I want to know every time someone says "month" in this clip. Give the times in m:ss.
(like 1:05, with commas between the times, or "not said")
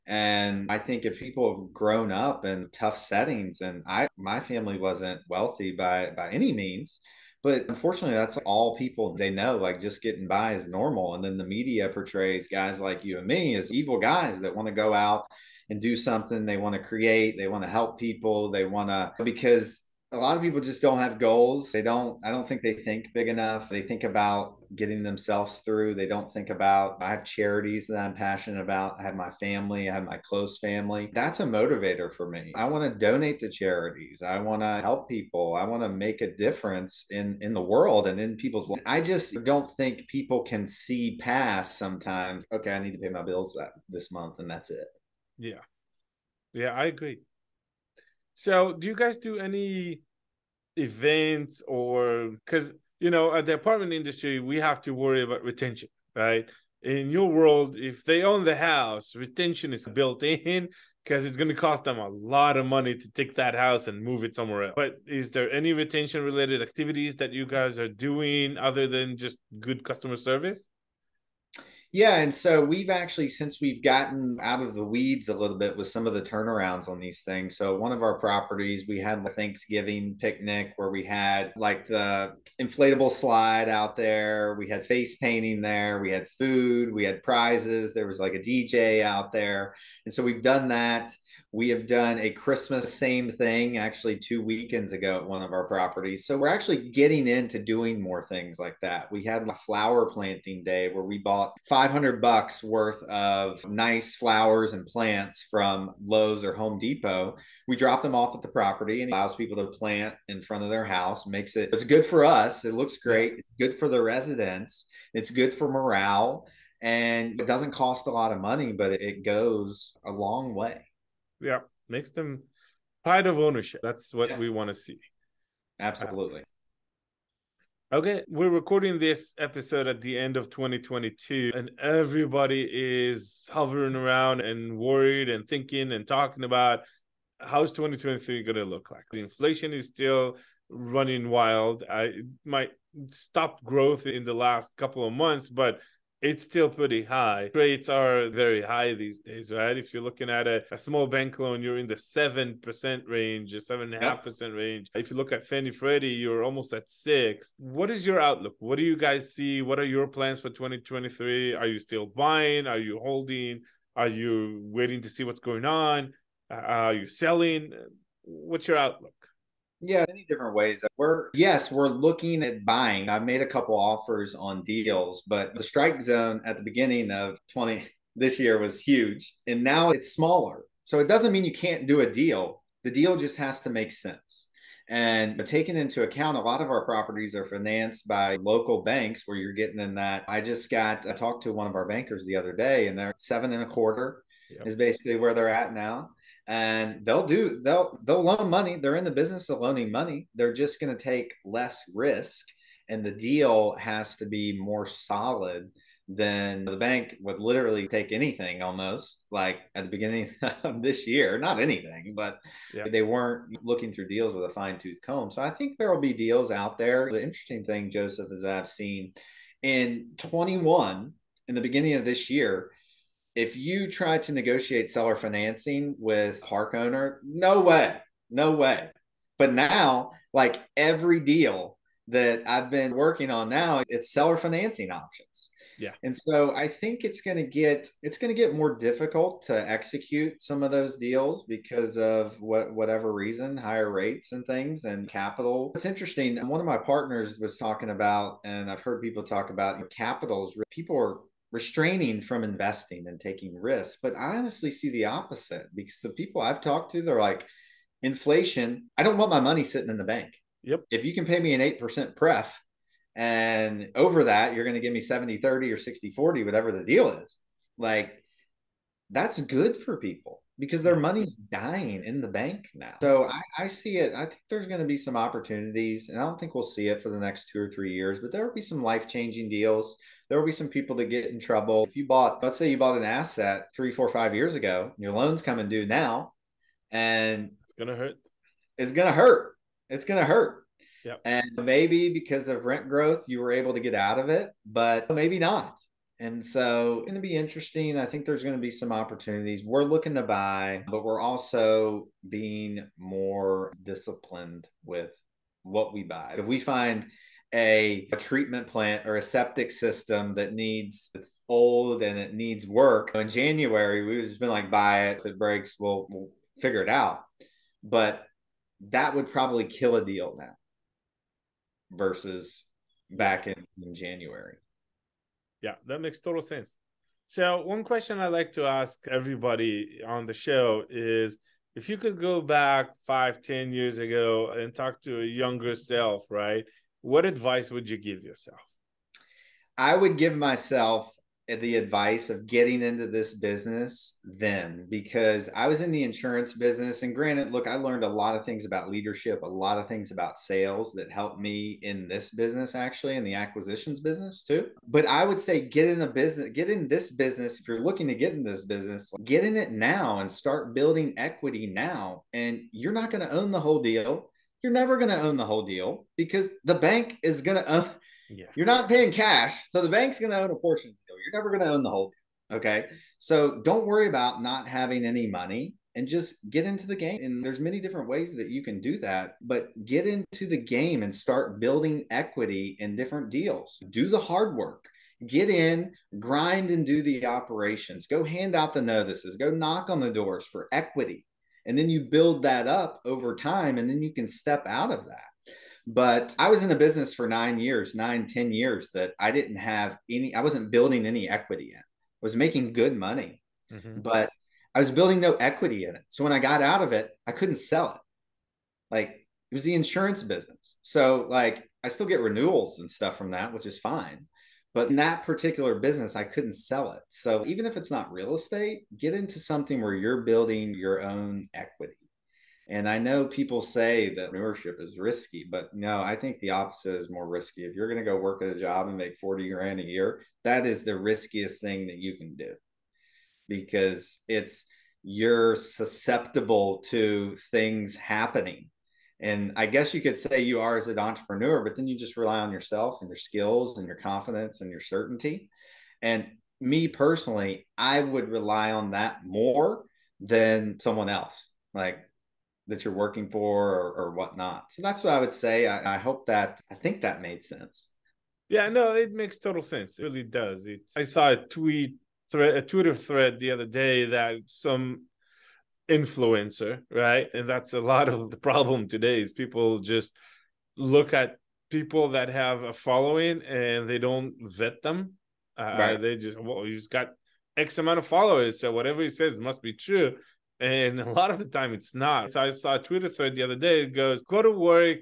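0:44, 2:25.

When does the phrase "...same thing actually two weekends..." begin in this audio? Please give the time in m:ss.
1:32.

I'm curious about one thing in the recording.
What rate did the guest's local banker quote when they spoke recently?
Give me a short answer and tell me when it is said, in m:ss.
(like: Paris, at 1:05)
Seven and a quarter, at 3:13.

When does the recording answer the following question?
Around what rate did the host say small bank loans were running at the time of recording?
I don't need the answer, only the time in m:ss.
2:33.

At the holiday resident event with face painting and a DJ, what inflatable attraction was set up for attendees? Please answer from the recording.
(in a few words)
Inflatable slide.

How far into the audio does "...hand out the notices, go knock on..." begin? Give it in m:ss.
6:28.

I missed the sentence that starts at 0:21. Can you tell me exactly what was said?
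They don't, I don't think they think big enough.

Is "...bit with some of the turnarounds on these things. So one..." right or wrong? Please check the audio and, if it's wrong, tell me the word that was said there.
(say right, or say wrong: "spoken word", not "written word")
right.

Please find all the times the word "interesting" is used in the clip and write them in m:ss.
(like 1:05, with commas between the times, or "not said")
3:37, 4:05, 4:57.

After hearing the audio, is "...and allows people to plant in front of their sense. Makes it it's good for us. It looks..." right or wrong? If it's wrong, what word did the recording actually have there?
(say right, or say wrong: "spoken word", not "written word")
wrong: "house", not "sense".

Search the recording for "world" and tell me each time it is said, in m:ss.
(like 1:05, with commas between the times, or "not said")
0:37, 0:57.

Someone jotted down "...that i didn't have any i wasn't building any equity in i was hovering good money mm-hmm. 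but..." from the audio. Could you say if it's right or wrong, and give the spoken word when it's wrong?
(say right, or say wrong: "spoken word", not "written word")
wrong: "making", not "hovering".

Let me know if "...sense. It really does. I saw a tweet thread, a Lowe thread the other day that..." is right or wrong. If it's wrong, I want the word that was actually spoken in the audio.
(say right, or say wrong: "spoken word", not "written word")
wrong: "Twitter", not "Lowe".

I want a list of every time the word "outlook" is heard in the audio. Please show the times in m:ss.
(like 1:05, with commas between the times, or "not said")
2:38, 2:48.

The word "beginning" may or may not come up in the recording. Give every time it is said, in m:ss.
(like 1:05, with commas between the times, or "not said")
2:56, 3:29, 3:41.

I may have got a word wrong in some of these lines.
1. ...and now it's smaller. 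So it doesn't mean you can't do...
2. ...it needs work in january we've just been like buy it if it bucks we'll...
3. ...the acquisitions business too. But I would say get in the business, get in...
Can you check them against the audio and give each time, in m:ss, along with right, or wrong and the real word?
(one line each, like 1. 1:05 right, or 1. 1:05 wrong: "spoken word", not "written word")
1. 2:59 right
2. 5:12 wrong: "breaks", not "bucks"
3. 5:53 right.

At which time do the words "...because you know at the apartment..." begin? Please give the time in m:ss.
0:52.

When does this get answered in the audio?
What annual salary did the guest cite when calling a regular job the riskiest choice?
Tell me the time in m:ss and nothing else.
7:09.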